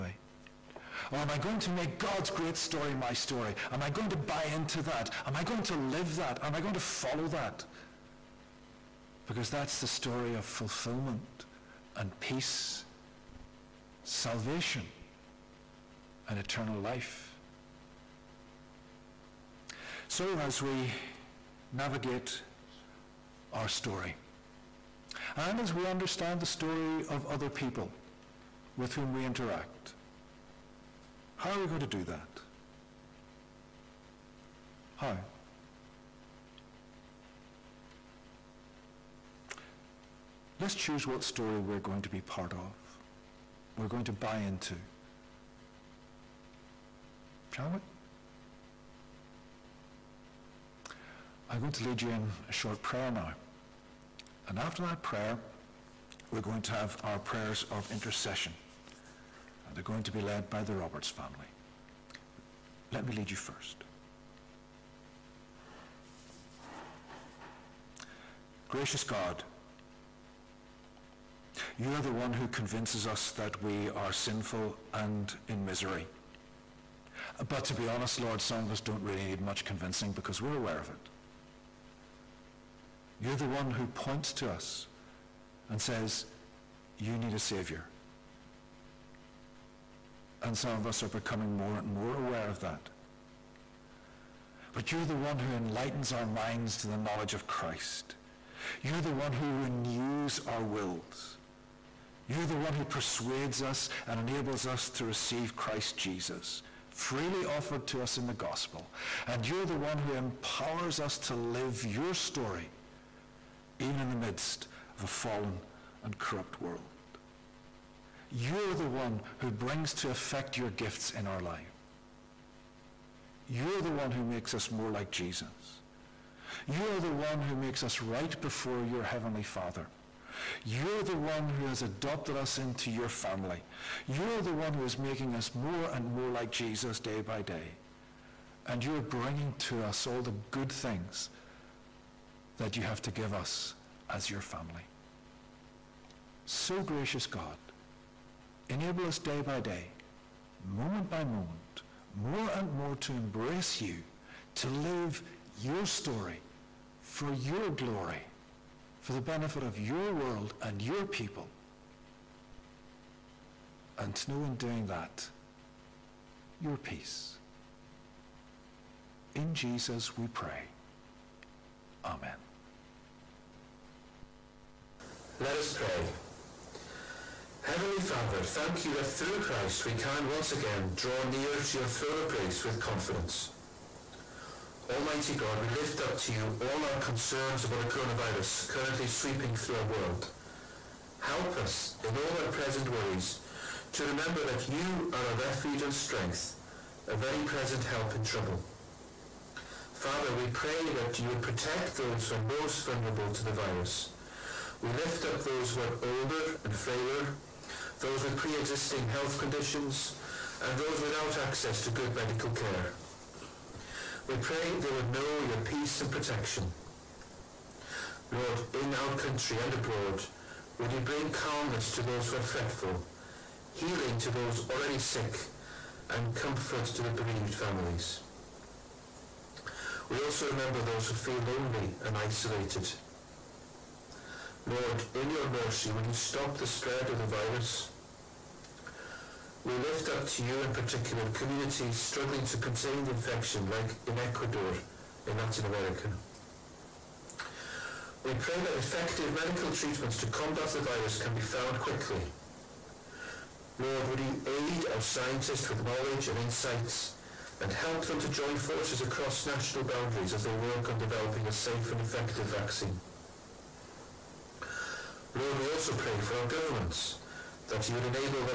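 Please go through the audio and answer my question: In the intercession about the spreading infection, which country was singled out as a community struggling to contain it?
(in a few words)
Ecuador.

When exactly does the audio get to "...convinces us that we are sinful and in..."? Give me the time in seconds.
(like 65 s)
72 s.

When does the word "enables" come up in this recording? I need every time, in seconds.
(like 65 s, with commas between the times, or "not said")
104 s, 148 s.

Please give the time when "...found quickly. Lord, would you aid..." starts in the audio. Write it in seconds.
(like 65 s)
251 s.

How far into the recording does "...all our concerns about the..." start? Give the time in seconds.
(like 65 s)
186 s.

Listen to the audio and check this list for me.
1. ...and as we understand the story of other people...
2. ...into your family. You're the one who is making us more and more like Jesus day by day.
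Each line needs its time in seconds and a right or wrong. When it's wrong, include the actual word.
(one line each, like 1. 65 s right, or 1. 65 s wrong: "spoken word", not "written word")
1. 25 s right
2. 132 s right.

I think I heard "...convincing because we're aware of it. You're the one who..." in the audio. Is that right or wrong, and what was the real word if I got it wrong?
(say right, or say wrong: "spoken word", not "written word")
right.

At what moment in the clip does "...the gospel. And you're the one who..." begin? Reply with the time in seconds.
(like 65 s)
108 s.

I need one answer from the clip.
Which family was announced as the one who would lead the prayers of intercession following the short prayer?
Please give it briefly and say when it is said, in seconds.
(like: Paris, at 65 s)
The Roberts family, at 60 s.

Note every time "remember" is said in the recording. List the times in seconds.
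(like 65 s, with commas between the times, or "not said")
194 s, 230 s.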